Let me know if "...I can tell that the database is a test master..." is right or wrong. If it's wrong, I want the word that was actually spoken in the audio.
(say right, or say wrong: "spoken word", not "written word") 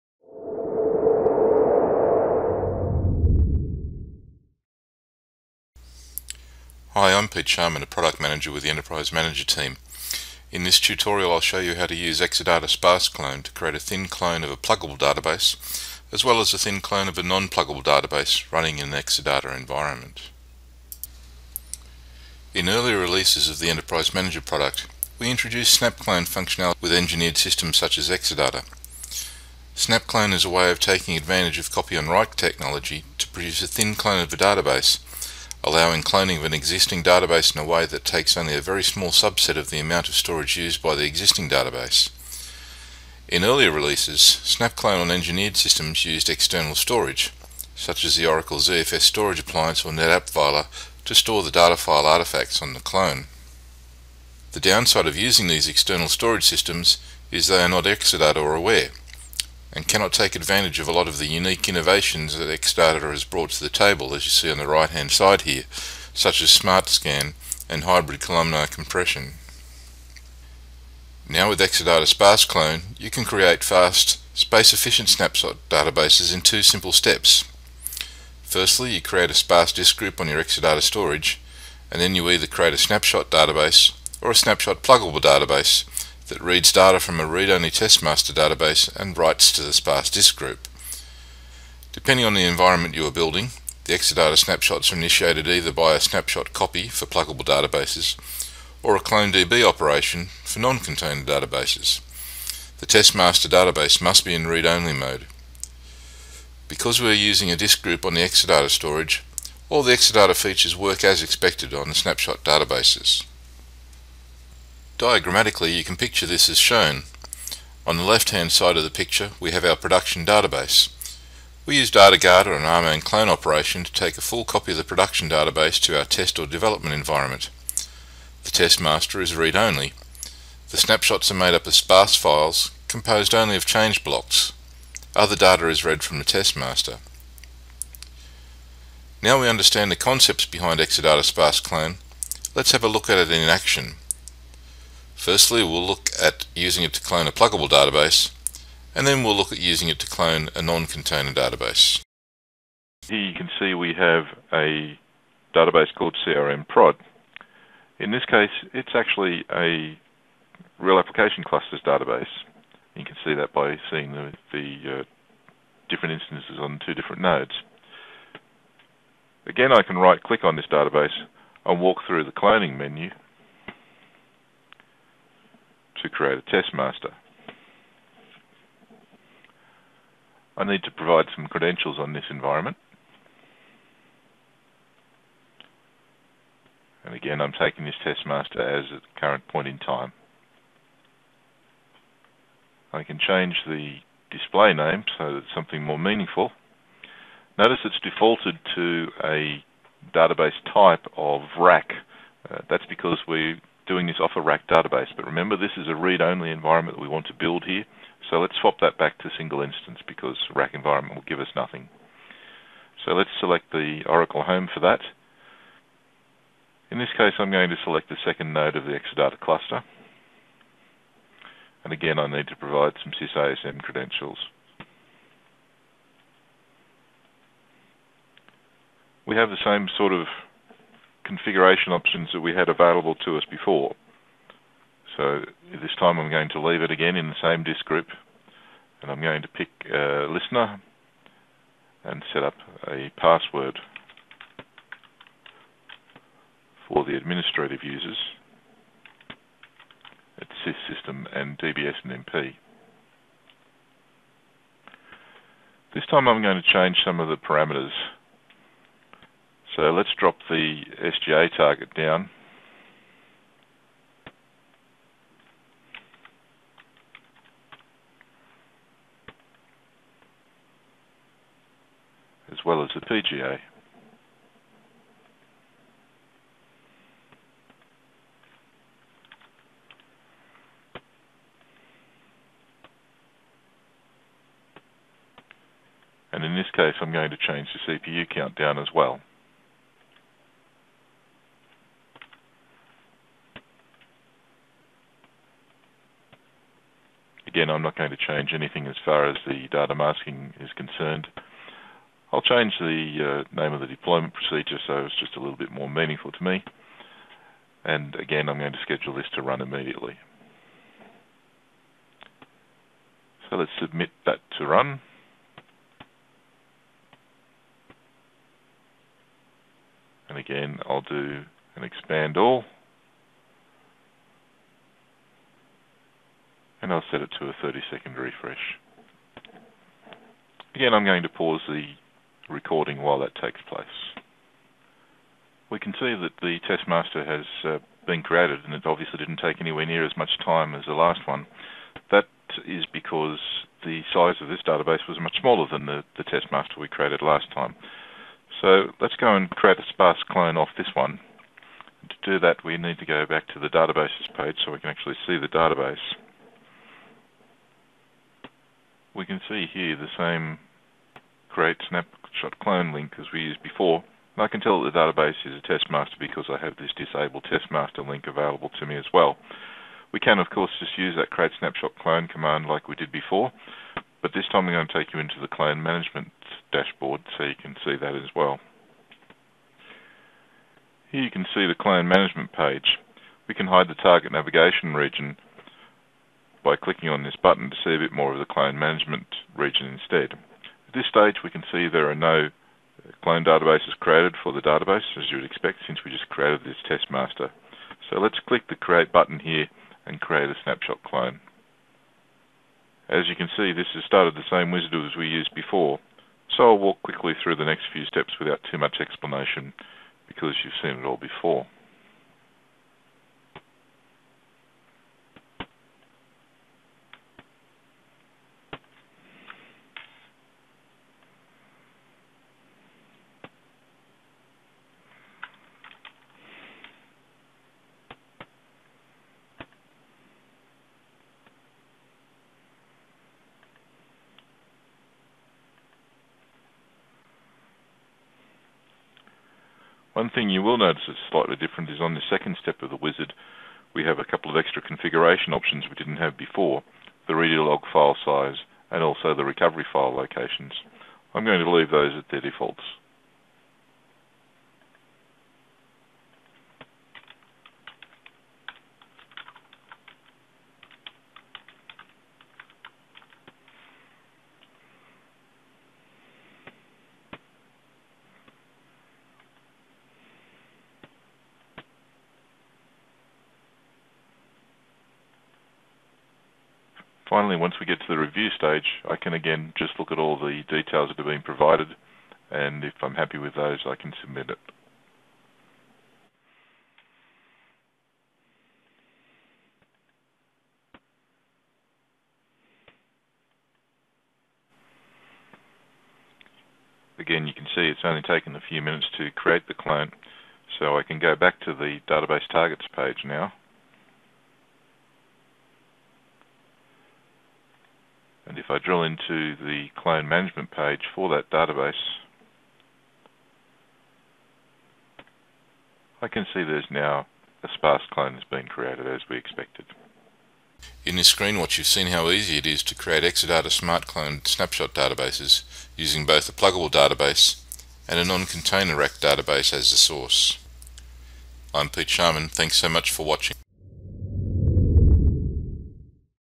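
right.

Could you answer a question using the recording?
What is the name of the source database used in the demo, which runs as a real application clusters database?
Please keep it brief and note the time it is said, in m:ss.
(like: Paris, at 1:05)
CRM prod, at 2:36.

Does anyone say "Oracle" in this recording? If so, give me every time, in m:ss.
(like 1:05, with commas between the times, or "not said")
0:48, 3:34.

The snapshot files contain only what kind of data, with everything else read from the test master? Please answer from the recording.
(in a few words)
change blocks.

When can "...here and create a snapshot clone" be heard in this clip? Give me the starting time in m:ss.
6:39.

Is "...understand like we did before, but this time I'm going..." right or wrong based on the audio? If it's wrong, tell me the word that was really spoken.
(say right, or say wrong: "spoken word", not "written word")
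wrong: "command", not "understand".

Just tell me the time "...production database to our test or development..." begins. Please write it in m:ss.
2:04.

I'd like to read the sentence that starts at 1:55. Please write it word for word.
Diagrammatically, you can picture this as shown.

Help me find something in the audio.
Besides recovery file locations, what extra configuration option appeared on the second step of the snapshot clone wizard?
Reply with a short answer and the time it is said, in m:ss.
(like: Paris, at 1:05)
redo log file size, at 7:27.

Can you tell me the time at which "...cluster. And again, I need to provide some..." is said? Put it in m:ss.
3:39.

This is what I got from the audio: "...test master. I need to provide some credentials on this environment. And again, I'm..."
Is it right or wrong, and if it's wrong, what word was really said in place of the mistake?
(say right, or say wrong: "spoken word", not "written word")
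right.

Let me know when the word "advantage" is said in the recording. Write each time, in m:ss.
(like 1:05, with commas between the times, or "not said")
0:31, 1:00.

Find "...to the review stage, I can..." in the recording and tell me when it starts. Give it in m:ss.
7:58.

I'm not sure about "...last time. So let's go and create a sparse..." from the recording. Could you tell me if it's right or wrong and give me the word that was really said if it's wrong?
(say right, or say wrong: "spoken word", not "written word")
right.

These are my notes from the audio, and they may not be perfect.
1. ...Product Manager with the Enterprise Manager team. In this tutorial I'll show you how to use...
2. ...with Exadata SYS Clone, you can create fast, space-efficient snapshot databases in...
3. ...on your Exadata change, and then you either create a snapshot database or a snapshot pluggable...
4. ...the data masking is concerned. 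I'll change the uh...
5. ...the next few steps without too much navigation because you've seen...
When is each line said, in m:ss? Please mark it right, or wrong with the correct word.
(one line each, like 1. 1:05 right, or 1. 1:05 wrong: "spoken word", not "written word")
1. 0:07 right
2. 1:11 wrong: "Sparse", not "SYS"
3. 1:20 wrong: "storage", not "change"
4. 4:59 right
5. 6:47 wrong: "explanation", not "navigation".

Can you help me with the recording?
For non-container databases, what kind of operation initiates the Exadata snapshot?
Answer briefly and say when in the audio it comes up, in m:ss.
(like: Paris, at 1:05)
clone DB operation, at 1:39.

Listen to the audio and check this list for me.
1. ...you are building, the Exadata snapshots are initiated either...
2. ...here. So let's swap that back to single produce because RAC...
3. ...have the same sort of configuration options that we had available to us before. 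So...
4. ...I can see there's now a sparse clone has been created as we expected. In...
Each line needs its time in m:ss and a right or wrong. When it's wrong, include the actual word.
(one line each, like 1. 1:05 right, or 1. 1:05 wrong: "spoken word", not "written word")
1. 1:32 right
2. 3:27 wrong: "instance", not "produce"
3. 3:49 right
4. 8:36 right.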